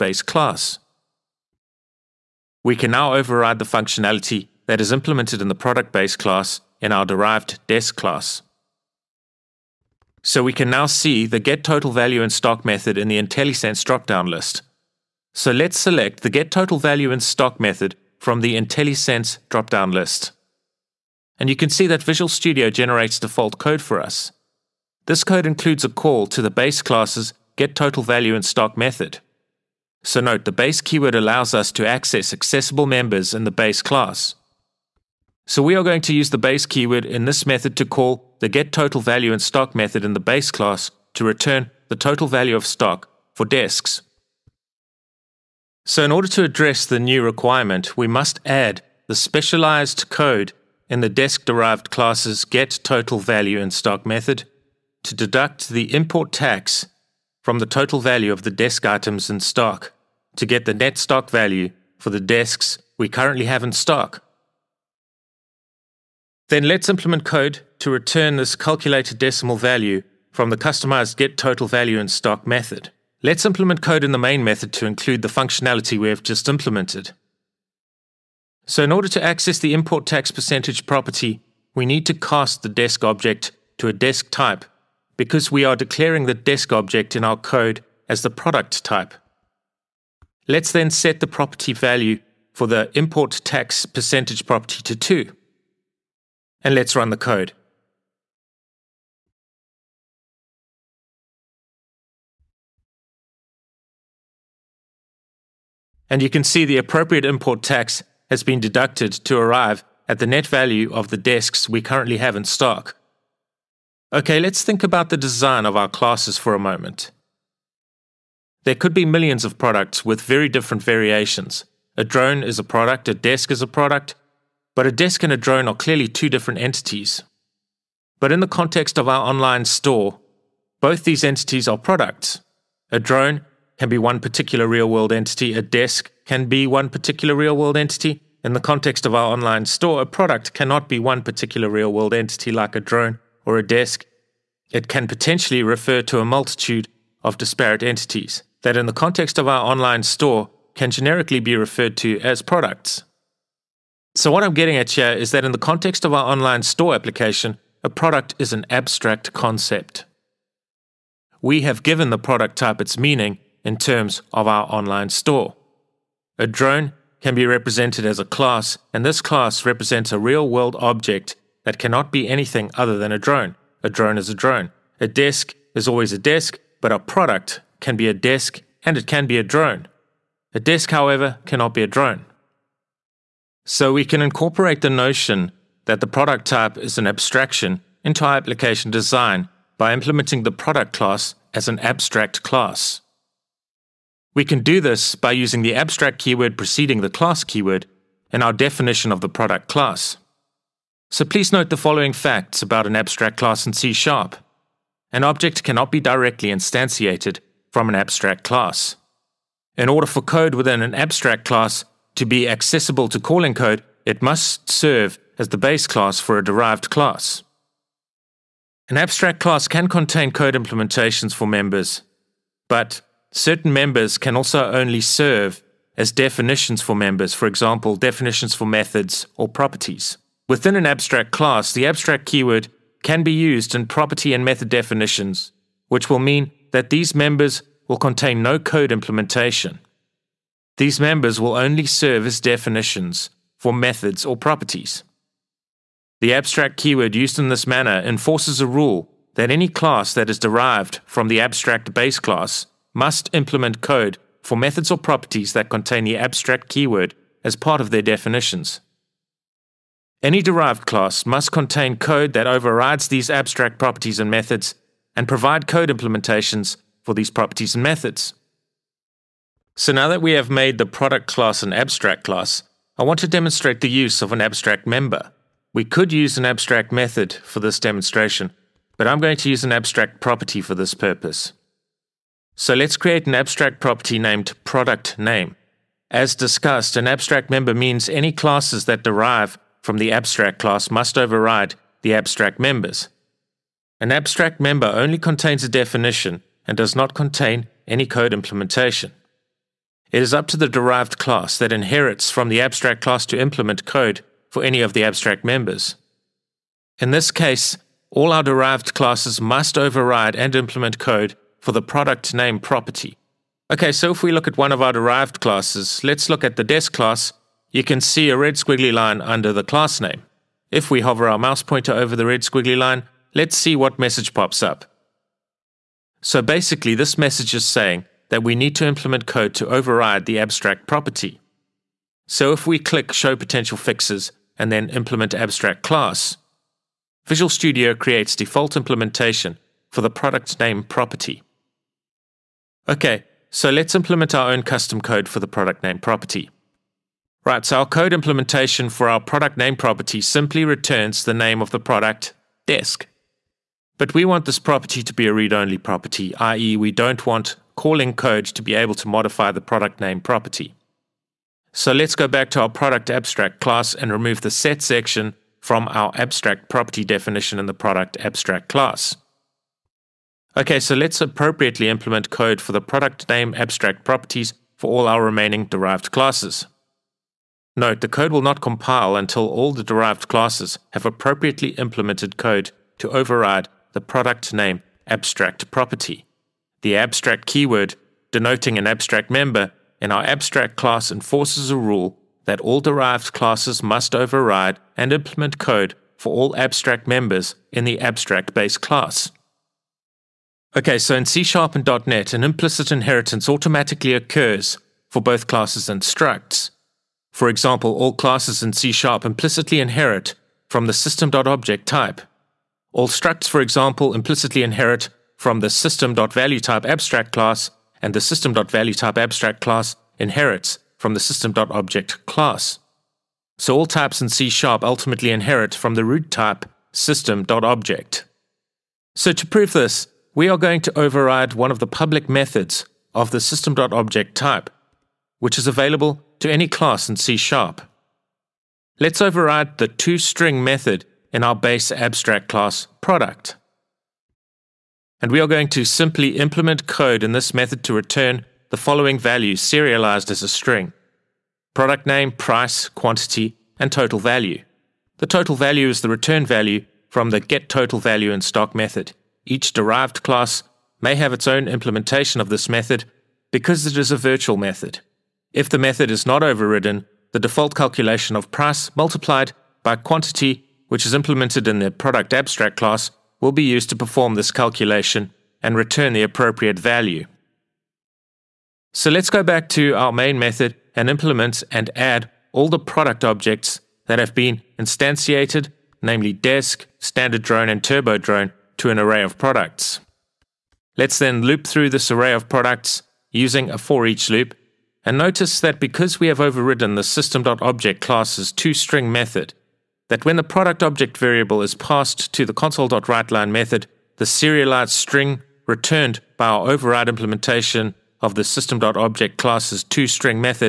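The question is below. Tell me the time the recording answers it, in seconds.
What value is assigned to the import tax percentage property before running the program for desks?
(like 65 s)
94 s.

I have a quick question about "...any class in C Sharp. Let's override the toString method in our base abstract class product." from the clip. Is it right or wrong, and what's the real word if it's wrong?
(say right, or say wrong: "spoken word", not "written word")
right.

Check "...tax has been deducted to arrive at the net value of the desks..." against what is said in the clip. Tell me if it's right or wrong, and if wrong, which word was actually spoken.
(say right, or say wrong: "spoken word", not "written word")
right.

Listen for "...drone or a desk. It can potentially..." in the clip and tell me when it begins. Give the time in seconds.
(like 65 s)
142 s.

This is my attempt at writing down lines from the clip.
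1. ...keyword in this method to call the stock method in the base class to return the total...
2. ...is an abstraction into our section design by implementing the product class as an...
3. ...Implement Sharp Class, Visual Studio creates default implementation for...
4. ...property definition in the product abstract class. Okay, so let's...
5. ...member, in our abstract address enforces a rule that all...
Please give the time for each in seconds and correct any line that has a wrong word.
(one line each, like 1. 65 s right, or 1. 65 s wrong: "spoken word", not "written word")
1. 36 s wrong: "getTotalValueInStock", not "stock"
2. 186 s wrong: "application", not "section"
3. 334 s wrong: "Abstract", not "Sharp"
4. 366 s right
5. 389 s wrong: "class", not "address".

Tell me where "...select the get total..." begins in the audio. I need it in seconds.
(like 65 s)
15 s.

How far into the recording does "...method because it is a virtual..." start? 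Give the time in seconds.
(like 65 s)
462 s.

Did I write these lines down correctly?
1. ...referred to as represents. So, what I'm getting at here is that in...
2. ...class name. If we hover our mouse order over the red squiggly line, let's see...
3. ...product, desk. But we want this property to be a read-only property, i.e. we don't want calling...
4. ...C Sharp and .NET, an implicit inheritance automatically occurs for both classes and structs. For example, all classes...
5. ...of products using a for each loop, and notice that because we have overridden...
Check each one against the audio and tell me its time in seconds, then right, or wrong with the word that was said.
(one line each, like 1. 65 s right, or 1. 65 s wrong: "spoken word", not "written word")
1. 151 s wrong: "products", not "represents"
2. 319 s wrong: "pointer", not "order"
3. 351 s right
4. 401 s right
5. 492 s right.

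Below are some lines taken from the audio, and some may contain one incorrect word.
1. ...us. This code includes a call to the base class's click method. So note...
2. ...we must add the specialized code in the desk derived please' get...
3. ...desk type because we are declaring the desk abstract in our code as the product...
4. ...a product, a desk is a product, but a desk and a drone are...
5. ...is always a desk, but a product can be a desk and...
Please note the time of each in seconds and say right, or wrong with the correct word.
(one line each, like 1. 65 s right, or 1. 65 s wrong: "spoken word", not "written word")
1. 23 s wrong: "getTotalValueInStock", not "click"
2. 47 s wrong: "classes", not "please"
3. 83 s wrong: "object", not "abstract"
4. 122 s right
5. 175 s right.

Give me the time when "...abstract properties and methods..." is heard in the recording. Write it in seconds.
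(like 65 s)
263 s.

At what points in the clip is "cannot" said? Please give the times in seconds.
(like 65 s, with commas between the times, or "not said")
140 s, 171 s, 181 s, 205 s.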